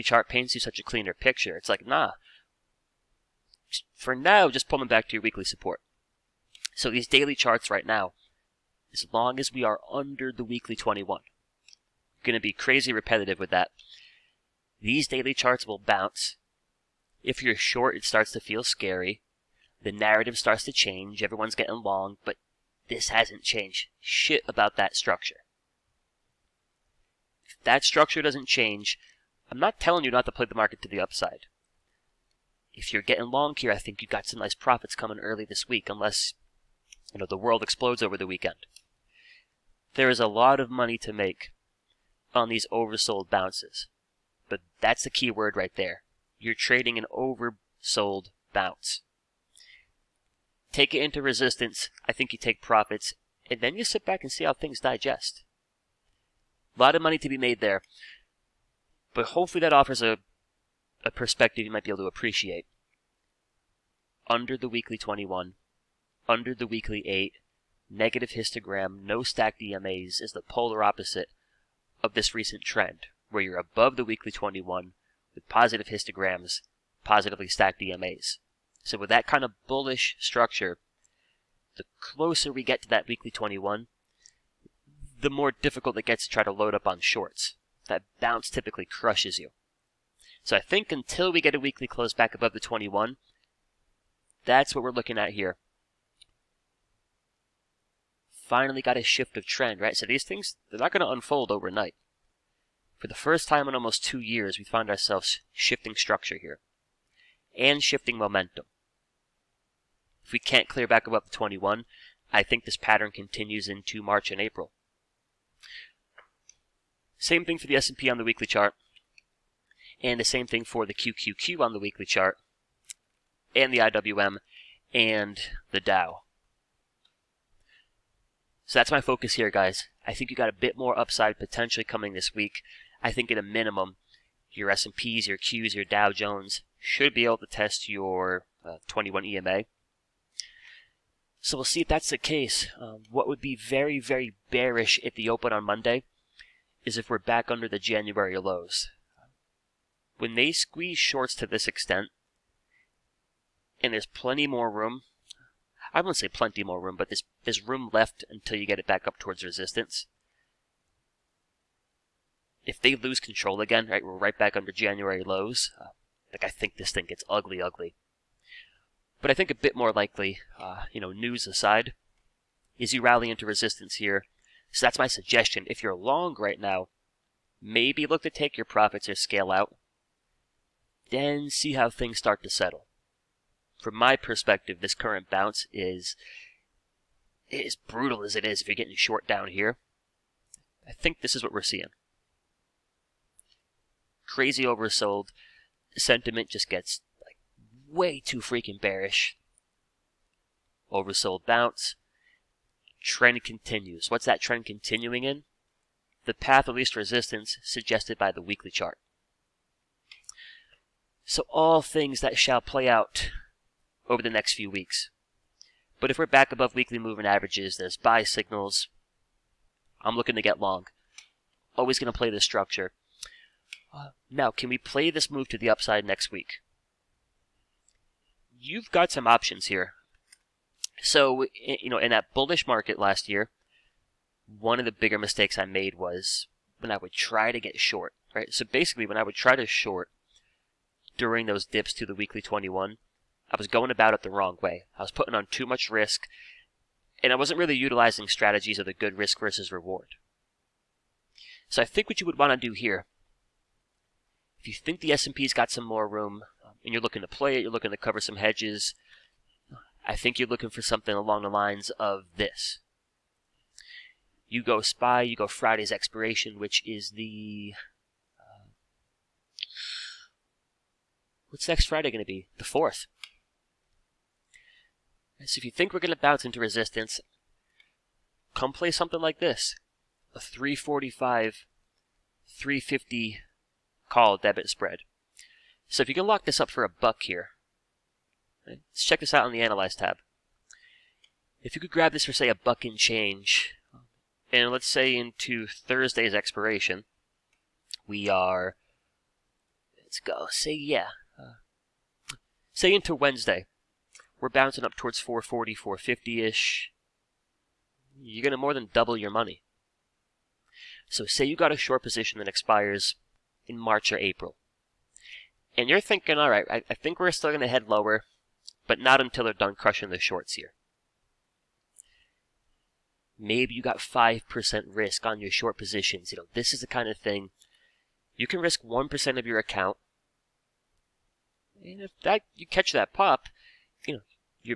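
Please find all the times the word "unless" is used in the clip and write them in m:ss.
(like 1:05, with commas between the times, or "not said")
0:35.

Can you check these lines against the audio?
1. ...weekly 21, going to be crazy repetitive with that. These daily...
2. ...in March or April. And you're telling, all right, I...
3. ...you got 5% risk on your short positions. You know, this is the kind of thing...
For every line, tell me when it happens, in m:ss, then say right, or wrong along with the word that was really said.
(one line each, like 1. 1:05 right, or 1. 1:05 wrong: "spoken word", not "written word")
1. 0:10 right
2. 5:13 wrong: "thinking", not "telling"
3. 5:23 right.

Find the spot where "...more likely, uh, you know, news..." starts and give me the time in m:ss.
2:49.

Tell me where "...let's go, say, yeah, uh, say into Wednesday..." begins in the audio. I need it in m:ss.
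5:00.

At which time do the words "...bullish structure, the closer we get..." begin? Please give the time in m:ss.
1:19.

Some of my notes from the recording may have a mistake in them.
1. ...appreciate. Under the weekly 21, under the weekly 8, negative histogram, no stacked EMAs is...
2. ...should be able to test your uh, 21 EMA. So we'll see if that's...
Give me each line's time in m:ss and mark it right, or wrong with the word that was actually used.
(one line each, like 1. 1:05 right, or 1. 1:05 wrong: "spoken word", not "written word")
1. 1:02 right
2. 2:16 right.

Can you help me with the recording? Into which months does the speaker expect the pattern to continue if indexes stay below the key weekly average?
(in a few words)
March and April.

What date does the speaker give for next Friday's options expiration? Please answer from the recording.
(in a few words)
The 4th.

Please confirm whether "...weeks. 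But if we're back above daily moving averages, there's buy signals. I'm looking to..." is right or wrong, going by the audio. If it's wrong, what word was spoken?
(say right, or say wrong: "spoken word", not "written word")
wrong: "weekly", not "daily".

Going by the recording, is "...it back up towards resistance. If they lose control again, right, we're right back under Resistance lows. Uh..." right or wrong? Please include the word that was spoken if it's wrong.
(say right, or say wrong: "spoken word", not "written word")
wrong: "January", not "Resistance".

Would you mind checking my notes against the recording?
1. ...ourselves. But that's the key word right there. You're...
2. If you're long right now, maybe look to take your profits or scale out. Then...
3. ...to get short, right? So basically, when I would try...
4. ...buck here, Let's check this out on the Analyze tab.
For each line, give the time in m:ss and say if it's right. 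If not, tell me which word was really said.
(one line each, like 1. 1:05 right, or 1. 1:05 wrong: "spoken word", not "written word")
1. 0:43 wrong: "bounces", not "ourselves"
2. 2:55 right
3. 3:57 right
4. 4:46 right.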